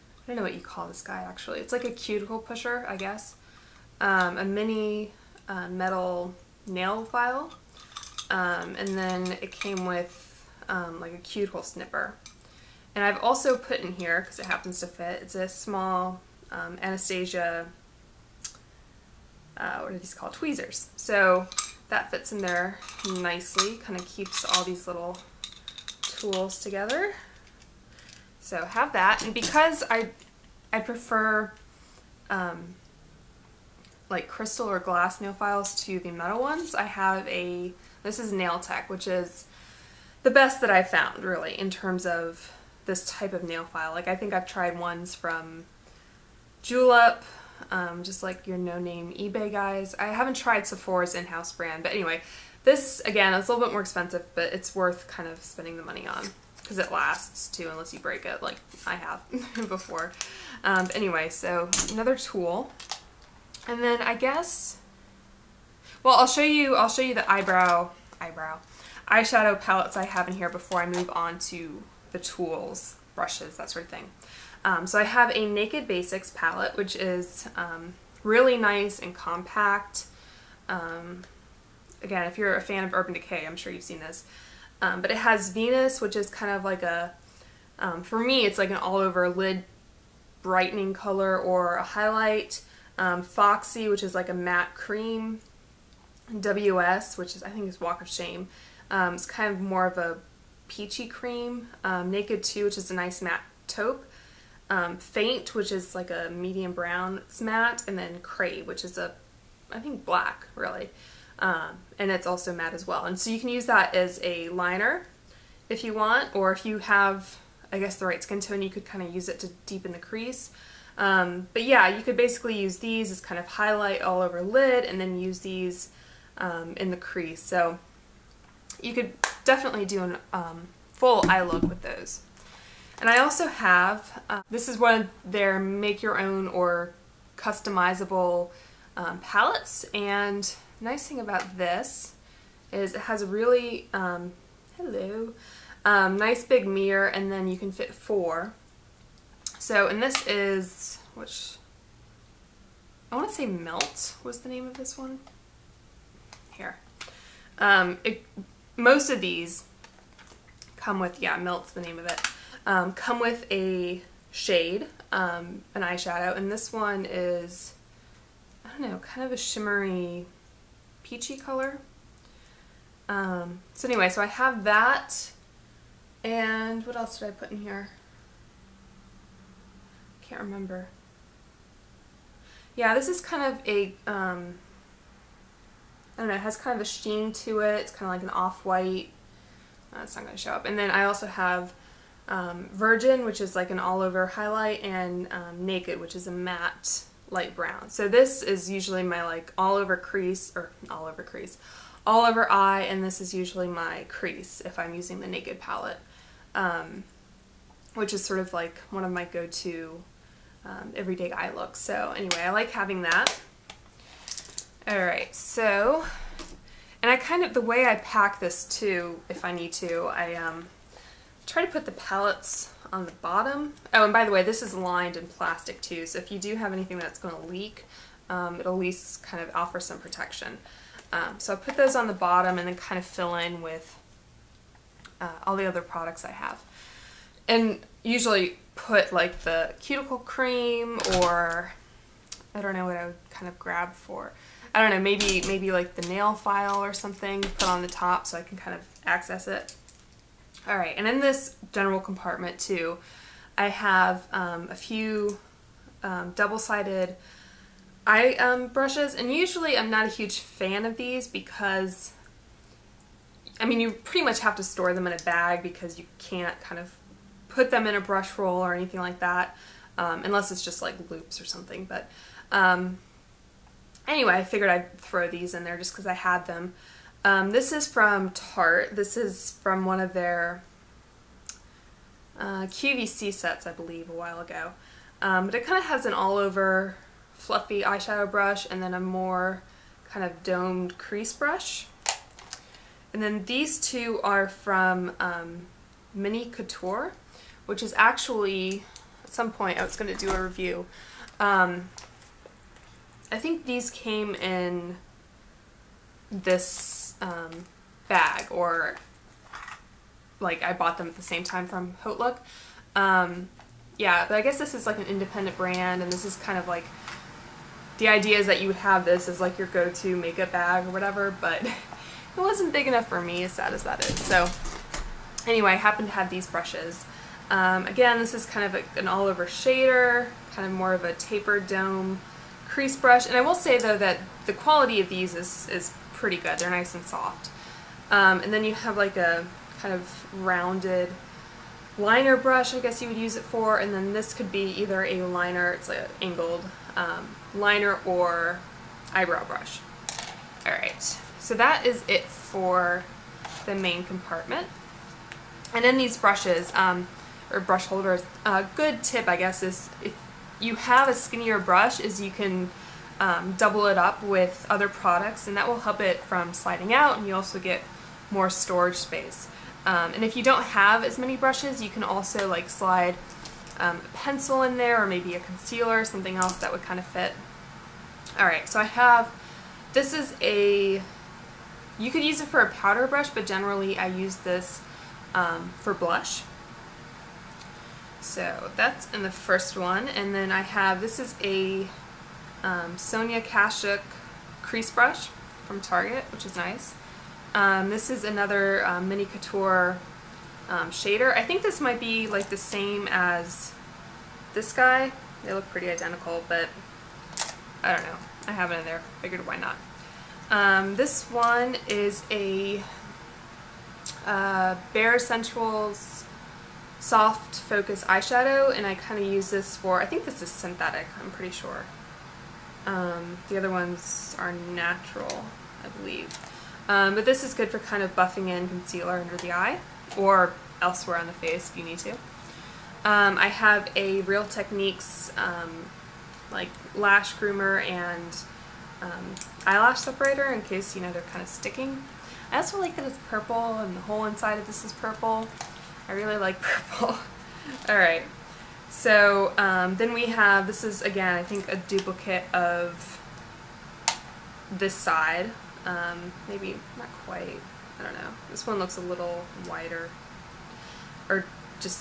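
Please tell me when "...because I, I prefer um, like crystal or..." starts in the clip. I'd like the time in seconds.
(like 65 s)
29 s.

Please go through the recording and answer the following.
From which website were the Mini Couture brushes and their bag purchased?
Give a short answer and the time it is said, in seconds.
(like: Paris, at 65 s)
HauteLook, at 312 s.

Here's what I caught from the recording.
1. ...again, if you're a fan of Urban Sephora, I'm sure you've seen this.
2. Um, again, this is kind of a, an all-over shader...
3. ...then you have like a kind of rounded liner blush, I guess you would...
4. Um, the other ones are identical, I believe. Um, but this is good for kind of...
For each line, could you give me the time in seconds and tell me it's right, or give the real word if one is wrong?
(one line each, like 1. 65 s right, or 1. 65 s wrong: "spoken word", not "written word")
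1. 82 s wrong: "Decay", not "Sephora"
2. 327 s right
3. 338 s wrong: "brush", not "blush"
4. 422 s wrong: "natural", not "identical".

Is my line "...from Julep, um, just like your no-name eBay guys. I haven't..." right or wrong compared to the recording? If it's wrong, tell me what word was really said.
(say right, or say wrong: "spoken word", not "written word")
right.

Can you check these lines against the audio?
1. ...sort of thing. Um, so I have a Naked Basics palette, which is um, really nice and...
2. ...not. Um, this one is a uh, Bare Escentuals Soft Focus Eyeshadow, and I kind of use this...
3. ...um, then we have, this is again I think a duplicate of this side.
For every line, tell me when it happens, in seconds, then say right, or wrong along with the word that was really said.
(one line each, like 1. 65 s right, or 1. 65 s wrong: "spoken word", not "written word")
1. 73 s right
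2. 409 s right
3. 449 s right.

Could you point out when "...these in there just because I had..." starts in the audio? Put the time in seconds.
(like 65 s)
275 s.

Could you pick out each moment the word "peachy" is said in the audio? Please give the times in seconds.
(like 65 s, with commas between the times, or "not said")
100 s, 171 s.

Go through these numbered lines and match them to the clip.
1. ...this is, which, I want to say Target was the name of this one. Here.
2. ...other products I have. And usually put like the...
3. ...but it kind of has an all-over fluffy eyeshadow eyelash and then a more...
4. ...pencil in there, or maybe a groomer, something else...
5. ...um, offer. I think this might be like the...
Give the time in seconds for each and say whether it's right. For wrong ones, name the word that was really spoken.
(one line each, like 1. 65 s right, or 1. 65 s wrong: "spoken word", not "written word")
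1. 150 s wrong: "Melt", not "Target"
2. 235 s right
3. 285 s wrong: "brush", not "eyelash"
4. 374 s wrong: "concealer", not "groomer"
5. 400 s wrong: "shader", not "offer".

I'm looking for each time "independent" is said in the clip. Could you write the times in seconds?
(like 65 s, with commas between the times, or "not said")
315 s.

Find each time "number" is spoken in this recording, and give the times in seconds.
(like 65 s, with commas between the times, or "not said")
not said.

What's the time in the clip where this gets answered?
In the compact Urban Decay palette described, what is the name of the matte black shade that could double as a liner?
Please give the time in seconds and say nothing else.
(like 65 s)
108 s.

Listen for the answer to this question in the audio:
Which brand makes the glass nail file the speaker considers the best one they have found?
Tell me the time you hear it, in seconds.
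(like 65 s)
38 s.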